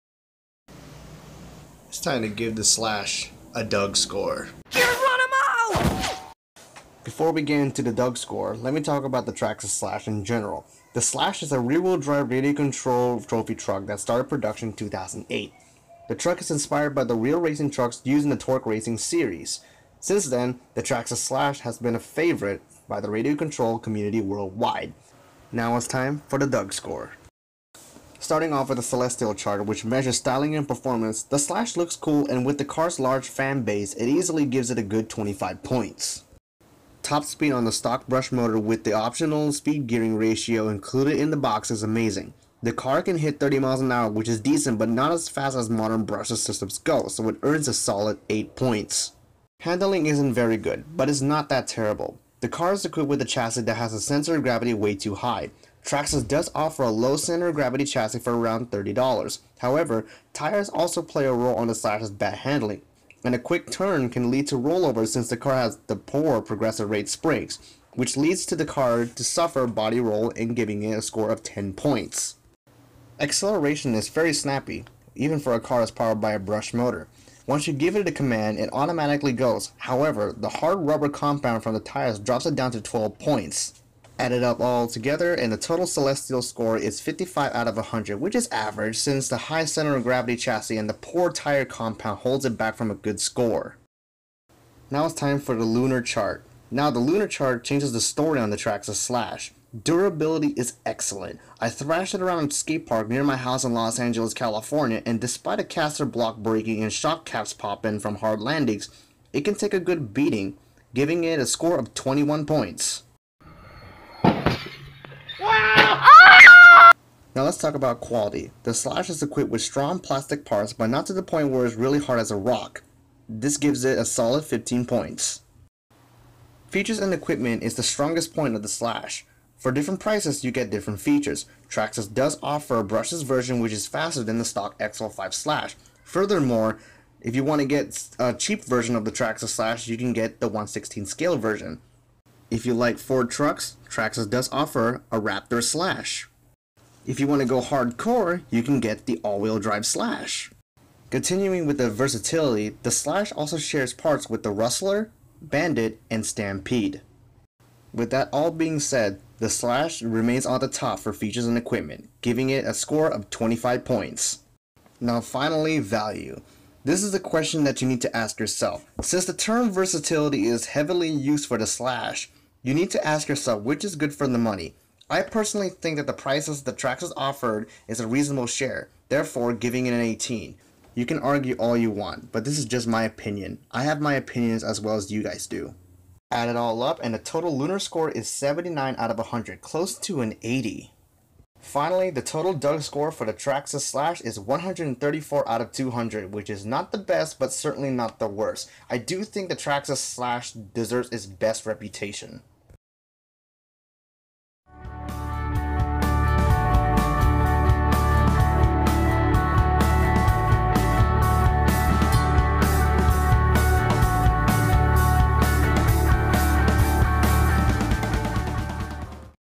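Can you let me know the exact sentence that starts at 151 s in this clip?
Continuing with the versatility, the Slash also shares parts with the Rustler, Bandit, and Stampede.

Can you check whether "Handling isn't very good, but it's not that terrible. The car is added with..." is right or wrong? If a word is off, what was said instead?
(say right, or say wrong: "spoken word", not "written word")
wrong: "equipped", not "added".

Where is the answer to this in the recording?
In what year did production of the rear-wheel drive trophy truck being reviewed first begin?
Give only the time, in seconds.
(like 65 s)
14 s.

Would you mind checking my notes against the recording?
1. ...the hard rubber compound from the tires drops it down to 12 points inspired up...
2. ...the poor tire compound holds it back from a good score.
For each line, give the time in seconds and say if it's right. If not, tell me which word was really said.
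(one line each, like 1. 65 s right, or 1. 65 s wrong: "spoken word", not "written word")
1. 80 s wrong: "added", not "inspired"
2. 90 s right.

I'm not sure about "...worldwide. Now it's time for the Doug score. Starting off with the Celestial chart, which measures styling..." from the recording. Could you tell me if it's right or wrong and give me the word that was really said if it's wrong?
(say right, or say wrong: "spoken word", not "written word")
right.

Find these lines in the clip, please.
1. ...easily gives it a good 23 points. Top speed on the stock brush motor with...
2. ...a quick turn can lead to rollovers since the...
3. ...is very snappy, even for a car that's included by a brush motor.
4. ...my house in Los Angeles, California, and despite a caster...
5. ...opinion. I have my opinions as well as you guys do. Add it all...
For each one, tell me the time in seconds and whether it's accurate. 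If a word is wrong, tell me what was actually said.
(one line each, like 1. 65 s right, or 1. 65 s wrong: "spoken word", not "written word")
1. 34 s wrong: "25", not "23"
2. 63 s right
3. 73 s wrong: "powered", not "included"
4. 103 s right
5. 183 s right.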